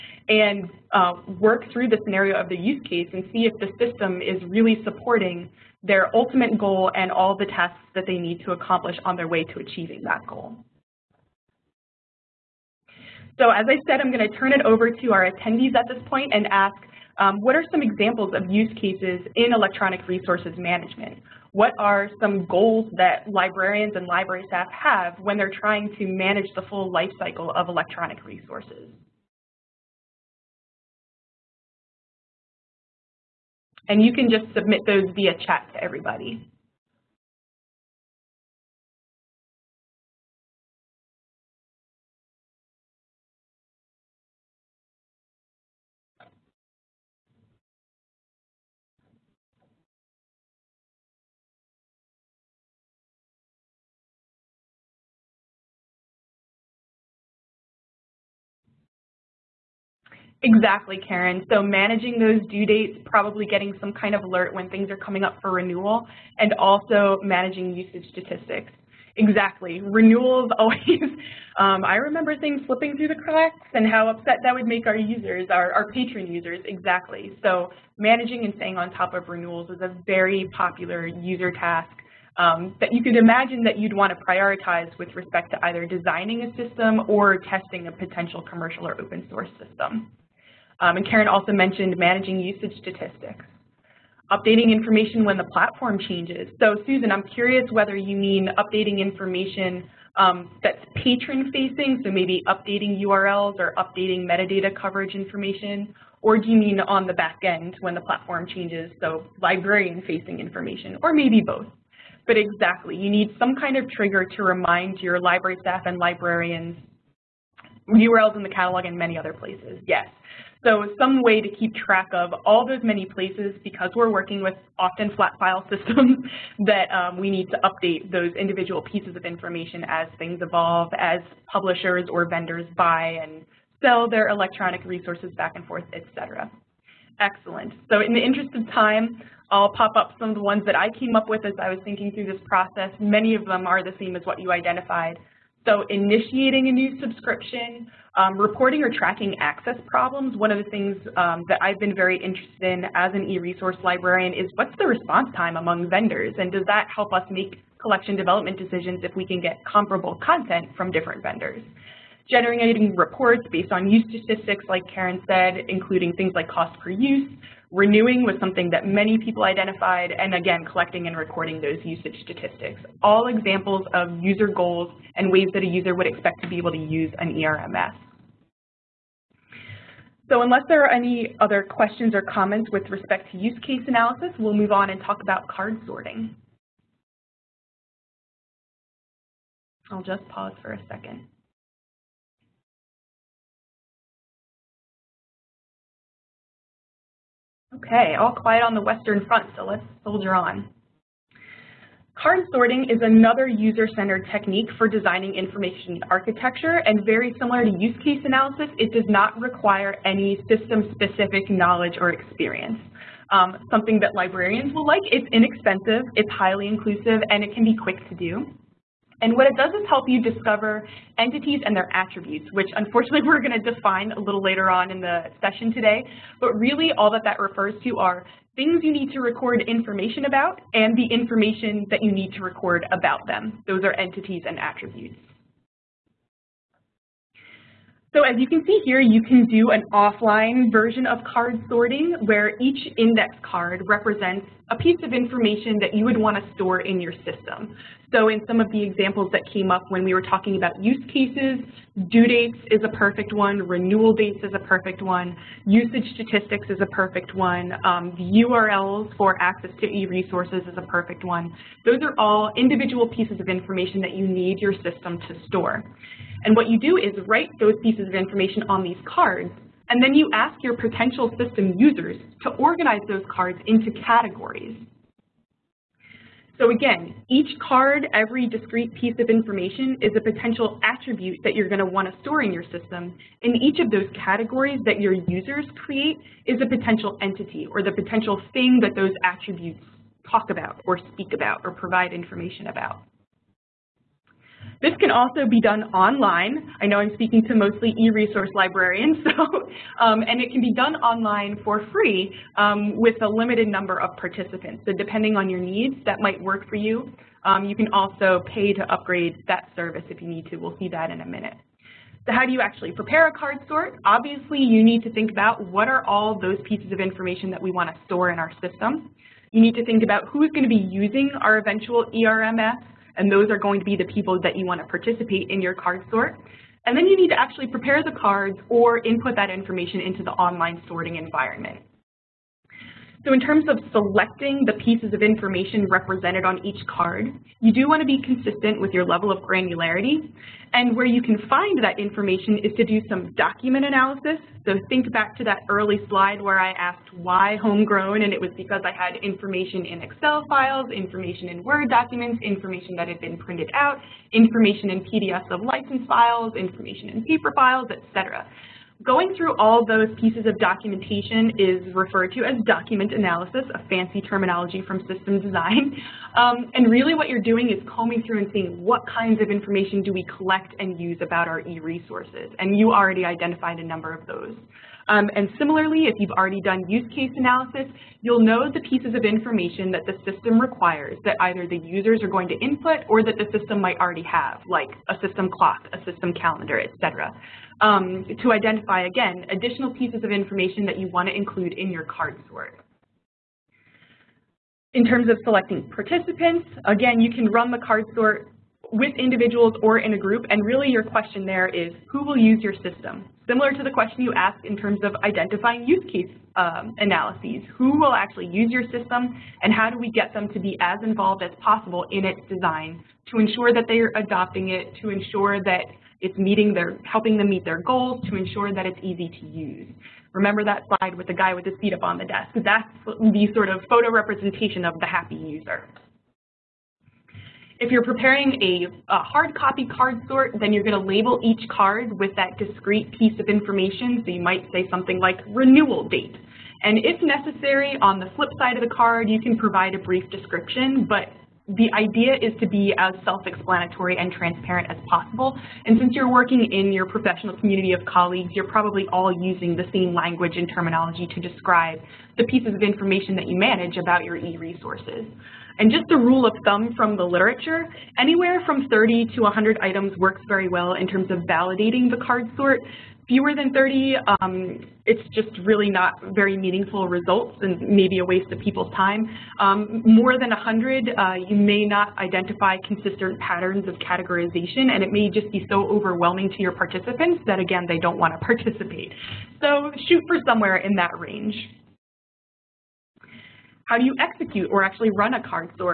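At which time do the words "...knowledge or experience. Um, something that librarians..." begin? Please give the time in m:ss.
3:31.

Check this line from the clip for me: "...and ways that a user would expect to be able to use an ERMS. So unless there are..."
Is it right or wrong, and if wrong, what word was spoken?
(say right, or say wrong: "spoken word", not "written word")
right.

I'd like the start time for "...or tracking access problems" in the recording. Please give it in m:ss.
2:28.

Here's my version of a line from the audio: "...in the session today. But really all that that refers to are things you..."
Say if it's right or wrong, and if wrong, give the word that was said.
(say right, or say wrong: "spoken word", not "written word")
right.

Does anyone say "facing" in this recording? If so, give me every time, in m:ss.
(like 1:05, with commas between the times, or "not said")
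1:40, 1:49.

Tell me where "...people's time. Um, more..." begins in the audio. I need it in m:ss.
7:48.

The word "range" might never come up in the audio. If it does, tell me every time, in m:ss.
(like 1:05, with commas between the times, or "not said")
8:01.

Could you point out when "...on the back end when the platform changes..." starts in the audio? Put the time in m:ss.
1:46.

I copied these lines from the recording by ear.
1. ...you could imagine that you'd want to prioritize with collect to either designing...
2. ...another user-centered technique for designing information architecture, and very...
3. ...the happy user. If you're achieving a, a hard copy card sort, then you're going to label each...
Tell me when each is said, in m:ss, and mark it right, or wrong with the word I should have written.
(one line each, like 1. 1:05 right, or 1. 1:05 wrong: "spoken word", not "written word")
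1. 1:22 wrong: "respect", not "collect"
2. 3:23 right
3. 7:04 wrong: "preparing", not "achieving".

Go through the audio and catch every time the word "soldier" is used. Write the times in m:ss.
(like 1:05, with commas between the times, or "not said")
3:20.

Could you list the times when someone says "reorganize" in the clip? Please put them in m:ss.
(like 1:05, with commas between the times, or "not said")
not said.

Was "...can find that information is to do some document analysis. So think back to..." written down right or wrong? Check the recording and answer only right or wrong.
right.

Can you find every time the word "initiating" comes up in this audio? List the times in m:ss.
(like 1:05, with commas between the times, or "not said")
2:25.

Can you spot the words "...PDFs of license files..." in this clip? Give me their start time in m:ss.
5:55.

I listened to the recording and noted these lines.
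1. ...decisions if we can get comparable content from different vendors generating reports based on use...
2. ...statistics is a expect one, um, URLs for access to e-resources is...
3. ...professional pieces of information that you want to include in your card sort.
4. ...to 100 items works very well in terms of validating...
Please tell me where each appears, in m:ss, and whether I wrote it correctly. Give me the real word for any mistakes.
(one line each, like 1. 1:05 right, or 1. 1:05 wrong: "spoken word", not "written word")
1. 2:38 right
2. 4:16 wrong: "perfect", not "expect"
3. 6:29 wrong: "additional", not "professional"
4. 7:39 right.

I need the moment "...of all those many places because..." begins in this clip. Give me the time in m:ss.
2:02.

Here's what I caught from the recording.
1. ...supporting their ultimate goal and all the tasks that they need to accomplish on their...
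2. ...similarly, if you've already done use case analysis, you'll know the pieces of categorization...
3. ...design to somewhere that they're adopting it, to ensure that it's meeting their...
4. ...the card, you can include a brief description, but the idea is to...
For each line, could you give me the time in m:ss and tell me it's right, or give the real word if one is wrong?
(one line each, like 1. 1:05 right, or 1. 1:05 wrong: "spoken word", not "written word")
1. 0:04 right
2. 6:15 wrong: "information", not "categorization"
3. 6:52 wrong: "ensure", not "somewhere"
4. 7:18 wrong: "provide", not "include".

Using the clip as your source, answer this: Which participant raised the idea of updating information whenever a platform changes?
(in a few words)
Susan.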